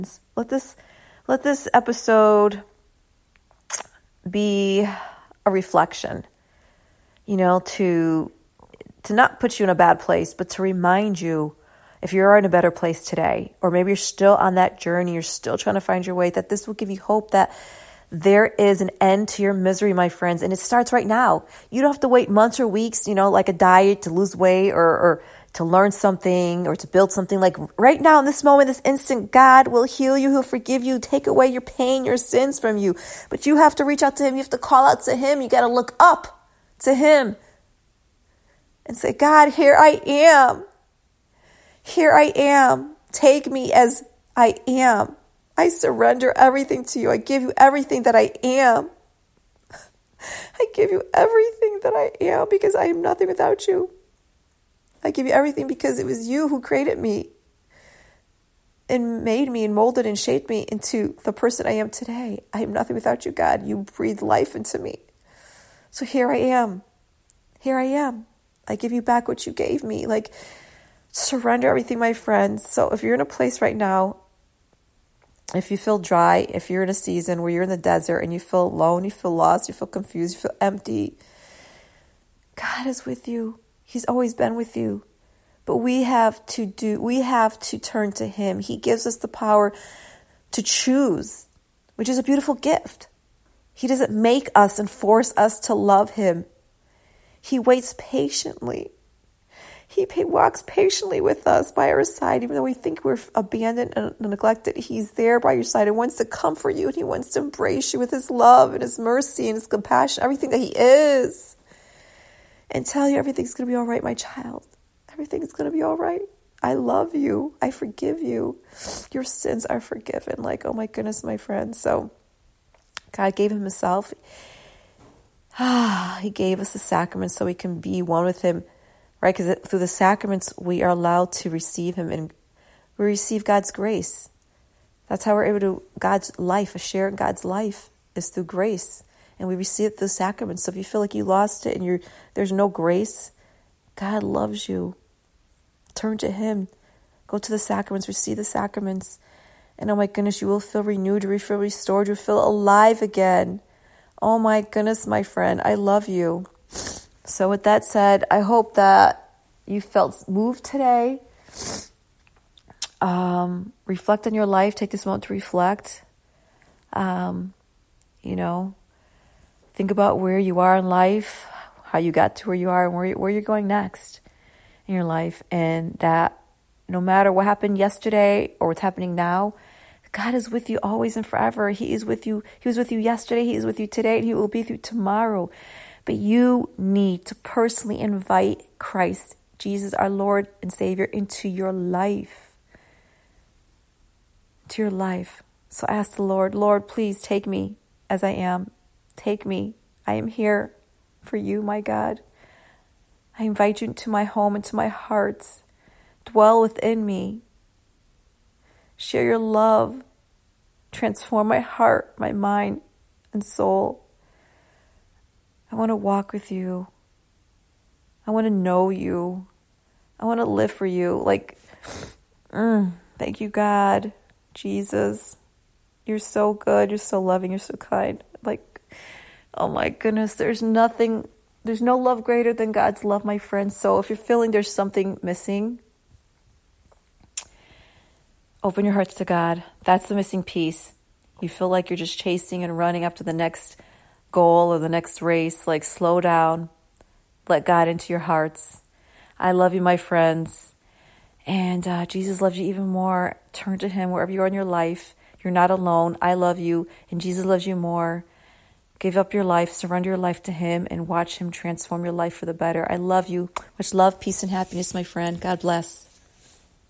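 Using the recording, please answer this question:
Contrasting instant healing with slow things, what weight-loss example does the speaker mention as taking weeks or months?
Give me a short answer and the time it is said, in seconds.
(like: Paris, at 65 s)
A diet, at 23 s.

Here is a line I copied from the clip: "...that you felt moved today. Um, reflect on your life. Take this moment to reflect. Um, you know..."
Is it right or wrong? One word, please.
right.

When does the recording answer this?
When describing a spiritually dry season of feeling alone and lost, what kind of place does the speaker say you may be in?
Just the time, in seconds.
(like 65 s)
77 s.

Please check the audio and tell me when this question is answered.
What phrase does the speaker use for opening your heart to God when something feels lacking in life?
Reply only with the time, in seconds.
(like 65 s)
240 s.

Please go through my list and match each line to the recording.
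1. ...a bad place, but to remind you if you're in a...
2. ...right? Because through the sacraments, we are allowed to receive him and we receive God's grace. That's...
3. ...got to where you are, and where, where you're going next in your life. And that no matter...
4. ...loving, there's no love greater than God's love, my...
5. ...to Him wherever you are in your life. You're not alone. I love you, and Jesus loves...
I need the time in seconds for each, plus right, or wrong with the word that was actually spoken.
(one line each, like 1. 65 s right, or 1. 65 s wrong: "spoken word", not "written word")
1. 9 s right
2. 129 s right
3. 172 s right
4. 230 s wrong: "nothing", not "loving"
5. 253 s right.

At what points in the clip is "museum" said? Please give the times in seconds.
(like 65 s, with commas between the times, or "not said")
not said.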